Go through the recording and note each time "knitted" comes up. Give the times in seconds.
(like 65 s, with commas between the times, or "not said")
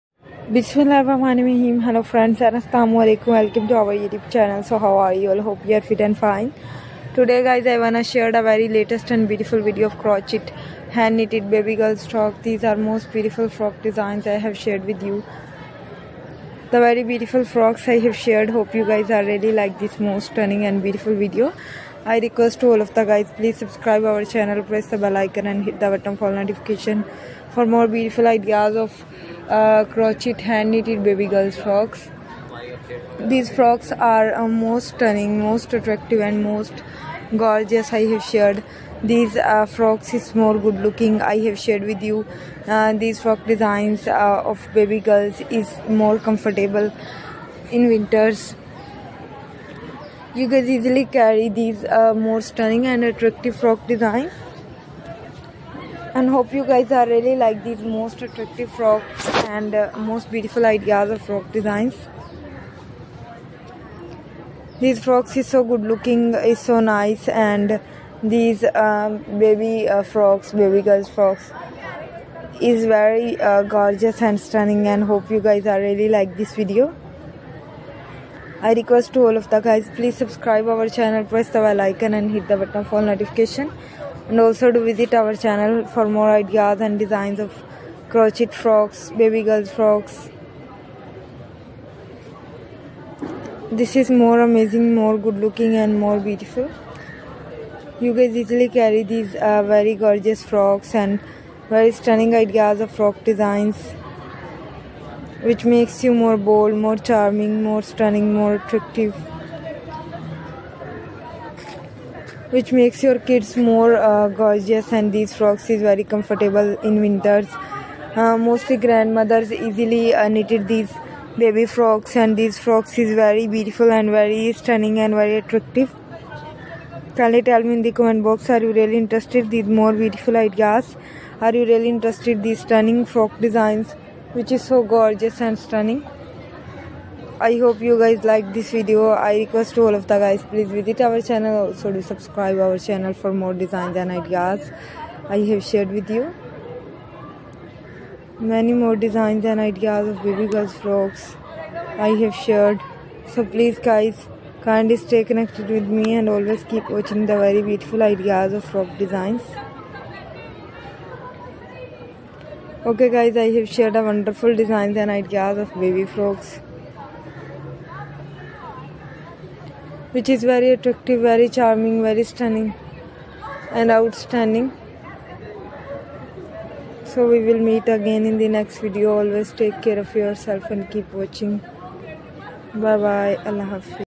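11 s, 30 s, 120 s.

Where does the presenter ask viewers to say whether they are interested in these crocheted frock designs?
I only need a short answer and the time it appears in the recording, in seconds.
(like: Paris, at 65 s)
comment box, at 128 s.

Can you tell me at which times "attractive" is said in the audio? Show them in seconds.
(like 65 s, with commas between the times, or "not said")
35 s, 53 s, 58 s, 108 s, 125 s, 170 s.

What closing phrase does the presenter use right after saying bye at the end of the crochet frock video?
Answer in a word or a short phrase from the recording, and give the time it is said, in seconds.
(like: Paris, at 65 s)
Allah Hafiz, at 183 s.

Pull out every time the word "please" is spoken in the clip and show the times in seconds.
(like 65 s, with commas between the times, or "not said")
23 s, 79 s, 140 s, 153 s.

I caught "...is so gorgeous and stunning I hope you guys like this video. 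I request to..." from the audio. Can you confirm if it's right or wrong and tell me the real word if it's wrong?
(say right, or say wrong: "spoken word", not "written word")
right.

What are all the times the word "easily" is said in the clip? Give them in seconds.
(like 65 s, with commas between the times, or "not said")
50 s, 98 s, 119 s.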